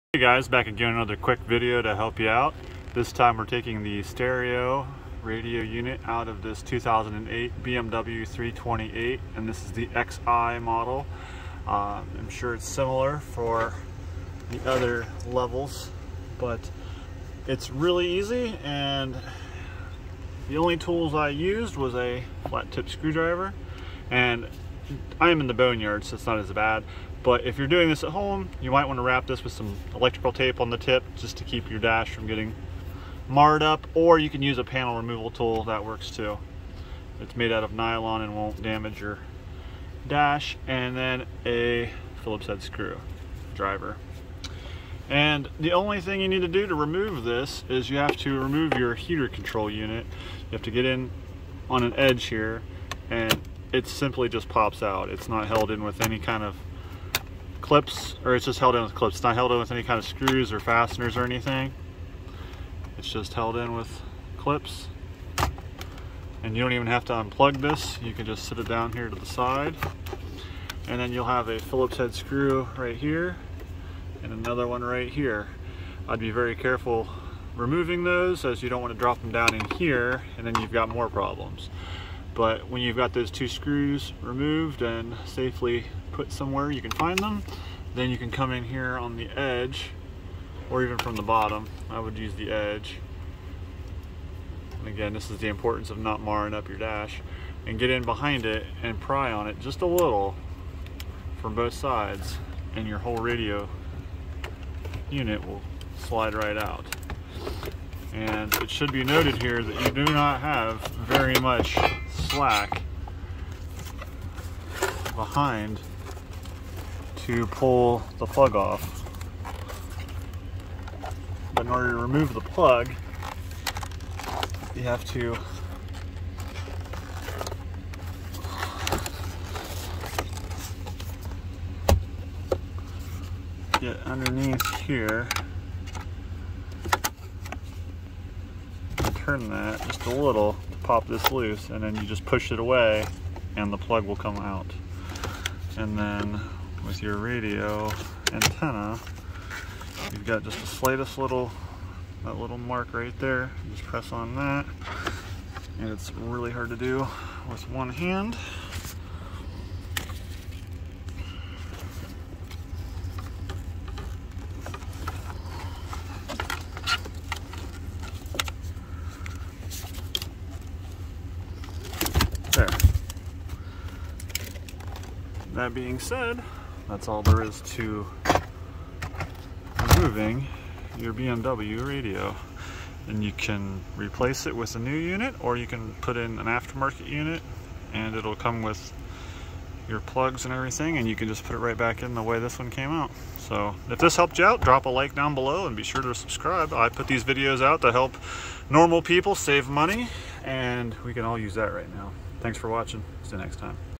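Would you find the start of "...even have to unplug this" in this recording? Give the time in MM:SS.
01:06.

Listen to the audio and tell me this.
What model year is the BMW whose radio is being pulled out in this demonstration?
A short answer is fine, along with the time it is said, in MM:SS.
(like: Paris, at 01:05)
2008, at 00:06.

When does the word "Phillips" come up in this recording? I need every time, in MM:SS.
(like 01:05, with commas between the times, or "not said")
00:42, 01:11.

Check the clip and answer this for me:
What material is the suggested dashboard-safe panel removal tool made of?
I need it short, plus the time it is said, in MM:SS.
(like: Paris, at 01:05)
Nylon, at 00:37.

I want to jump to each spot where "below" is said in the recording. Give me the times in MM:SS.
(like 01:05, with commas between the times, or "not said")
03:15.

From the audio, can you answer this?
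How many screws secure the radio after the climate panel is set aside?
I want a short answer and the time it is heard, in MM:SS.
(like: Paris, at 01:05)
2, at 01:23.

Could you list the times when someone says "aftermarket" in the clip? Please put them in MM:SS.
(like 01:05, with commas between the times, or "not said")
03:06.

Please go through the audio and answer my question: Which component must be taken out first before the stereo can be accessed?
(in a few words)
Heater control unit.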